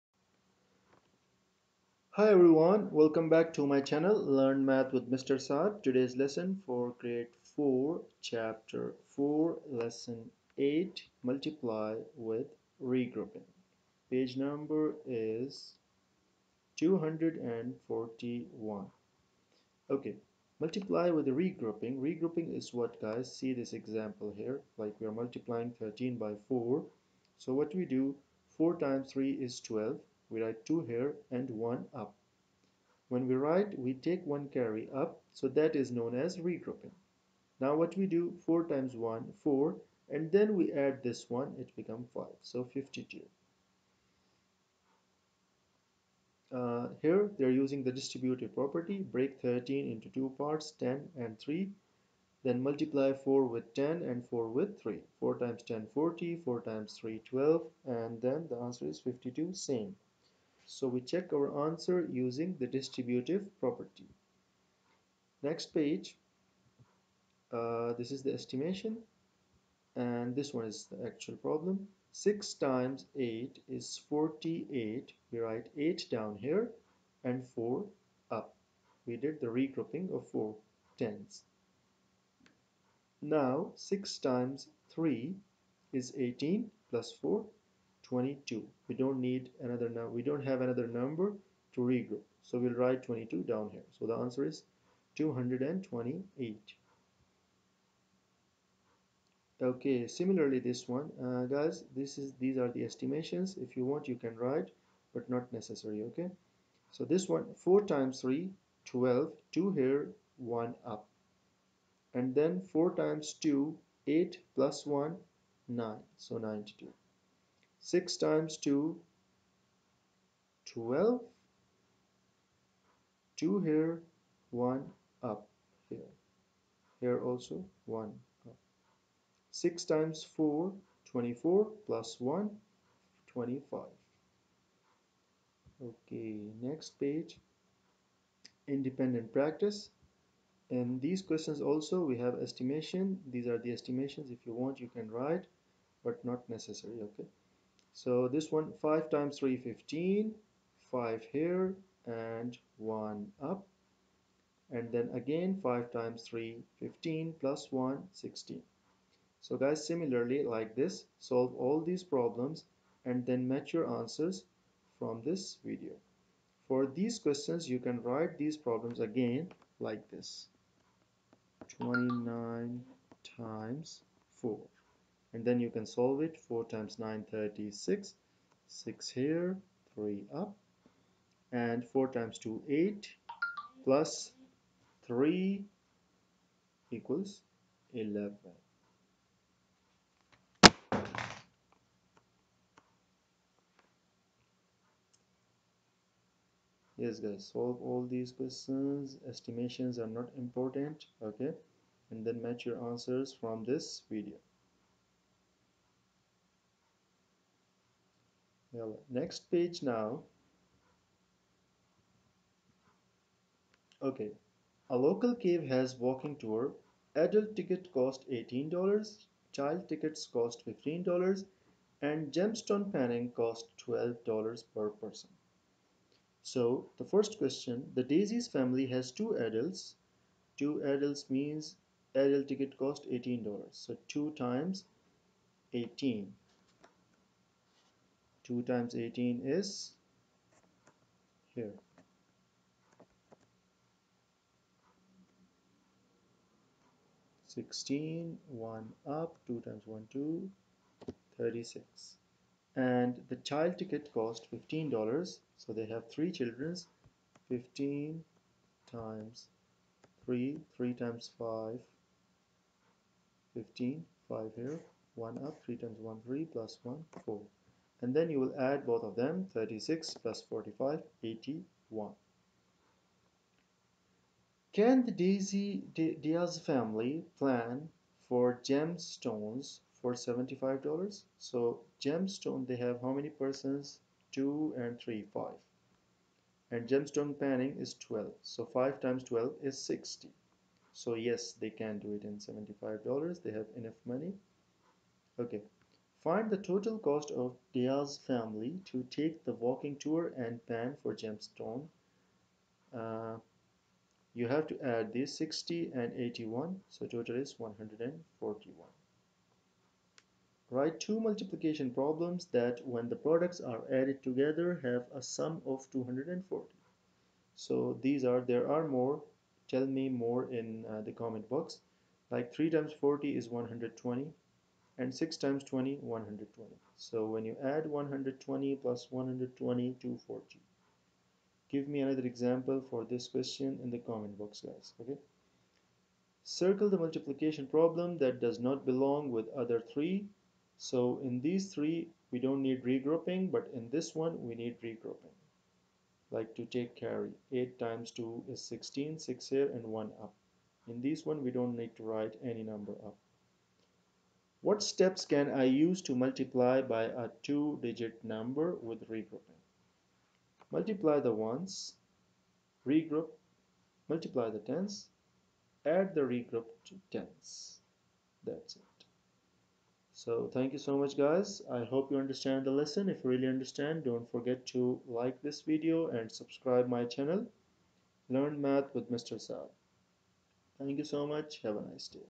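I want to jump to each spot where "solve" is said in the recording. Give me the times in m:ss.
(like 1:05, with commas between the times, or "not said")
2:41, 2:55, 3:17.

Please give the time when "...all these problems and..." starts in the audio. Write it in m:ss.
2:41.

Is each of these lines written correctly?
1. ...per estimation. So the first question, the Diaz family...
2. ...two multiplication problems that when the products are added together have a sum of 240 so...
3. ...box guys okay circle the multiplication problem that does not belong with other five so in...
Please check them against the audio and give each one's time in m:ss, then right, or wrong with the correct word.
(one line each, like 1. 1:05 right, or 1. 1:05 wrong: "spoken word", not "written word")
1. 3:44 wrong: "person", not "estimation"
2. 5:11 right
3. 5:34 wrong: "three", not "five".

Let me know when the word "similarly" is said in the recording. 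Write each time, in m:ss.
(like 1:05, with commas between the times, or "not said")
1:40, 2:39.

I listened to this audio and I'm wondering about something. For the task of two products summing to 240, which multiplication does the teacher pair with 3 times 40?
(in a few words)
6 times 20.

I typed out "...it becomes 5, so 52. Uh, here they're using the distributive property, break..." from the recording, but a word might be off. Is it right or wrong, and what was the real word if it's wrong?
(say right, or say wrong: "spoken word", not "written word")
right.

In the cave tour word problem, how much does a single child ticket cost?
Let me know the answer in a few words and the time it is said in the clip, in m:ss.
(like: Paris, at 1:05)
$15, at 3:39.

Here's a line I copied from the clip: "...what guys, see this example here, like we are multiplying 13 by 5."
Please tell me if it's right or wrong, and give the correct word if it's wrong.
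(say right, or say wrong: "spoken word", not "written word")
wrong: "4", not "5".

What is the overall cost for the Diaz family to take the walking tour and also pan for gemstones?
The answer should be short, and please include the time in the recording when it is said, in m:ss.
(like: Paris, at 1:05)
141, at 5:07.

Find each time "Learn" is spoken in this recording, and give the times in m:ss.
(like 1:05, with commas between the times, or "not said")
0:04, 6:18.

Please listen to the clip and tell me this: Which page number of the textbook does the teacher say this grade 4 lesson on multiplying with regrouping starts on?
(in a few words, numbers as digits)
241.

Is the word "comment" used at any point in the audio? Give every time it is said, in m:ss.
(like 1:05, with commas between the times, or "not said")
5:21, 5:34.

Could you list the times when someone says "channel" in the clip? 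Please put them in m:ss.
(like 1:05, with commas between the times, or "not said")
0:03, 6:17.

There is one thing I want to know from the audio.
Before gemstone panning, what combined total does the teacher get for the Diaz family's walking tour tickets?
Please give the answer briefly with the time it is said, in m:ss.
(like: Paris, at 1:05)
81, at 4:29.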